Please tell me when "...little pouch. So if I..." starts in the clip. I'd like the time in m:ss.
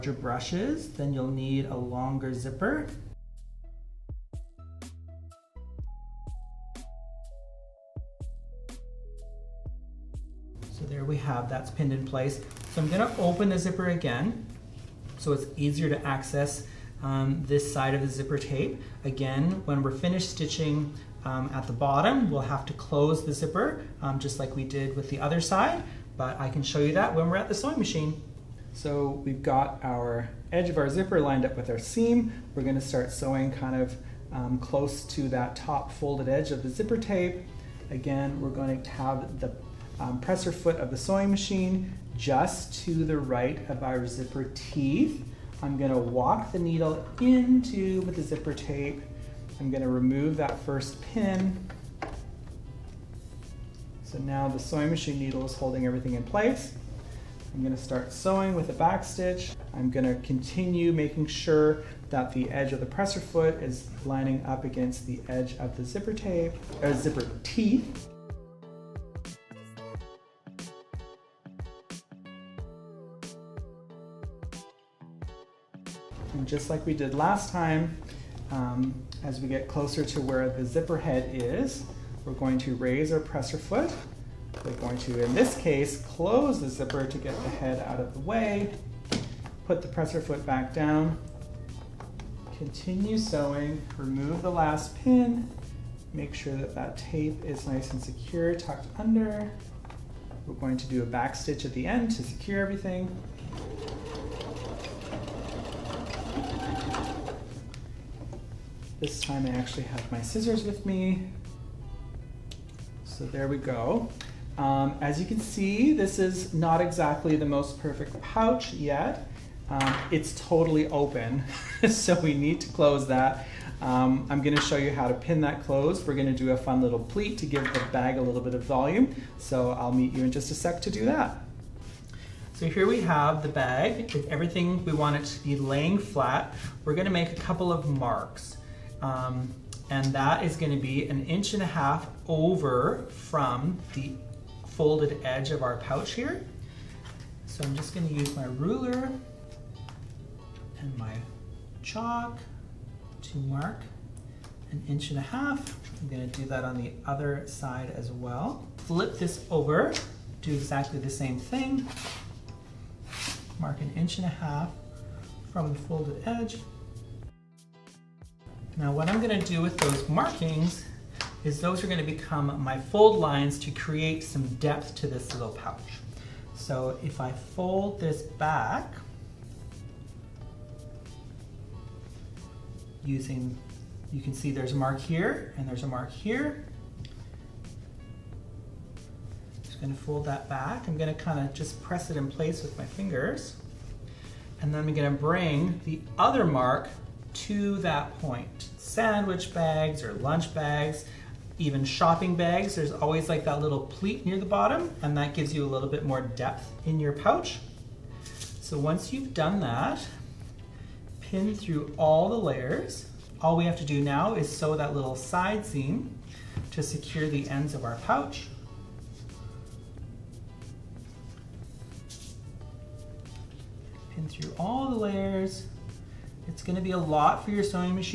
2:55.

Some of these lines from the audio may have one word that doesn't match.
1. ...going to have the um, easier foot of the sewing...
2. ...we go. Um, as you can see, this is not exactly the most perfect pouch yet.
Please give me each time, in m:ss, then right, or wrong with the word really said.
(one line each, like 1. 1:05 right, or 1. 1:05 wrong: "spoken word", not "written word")
1. 0:38 wrong: "presser", not "easier"
2. 1:53 right.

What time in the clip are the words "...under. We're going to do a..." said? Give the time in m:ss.
1:38.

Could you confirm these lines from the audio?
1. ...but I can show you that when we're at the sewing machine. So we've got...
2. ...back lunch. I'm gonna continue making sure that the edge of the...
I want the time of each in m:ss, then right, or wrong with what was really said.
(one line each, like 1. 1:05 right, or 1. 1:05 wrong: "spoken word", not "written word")
1. 0:26 right
2. 0:58 wrong: "stitch", not "lunch".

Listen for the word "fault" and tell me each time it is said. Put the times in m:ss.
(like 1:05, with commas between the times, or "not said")
not said.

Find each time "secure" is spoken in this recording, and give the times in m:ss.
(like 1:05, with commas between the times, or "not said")
1:38, 1:42, 3:36.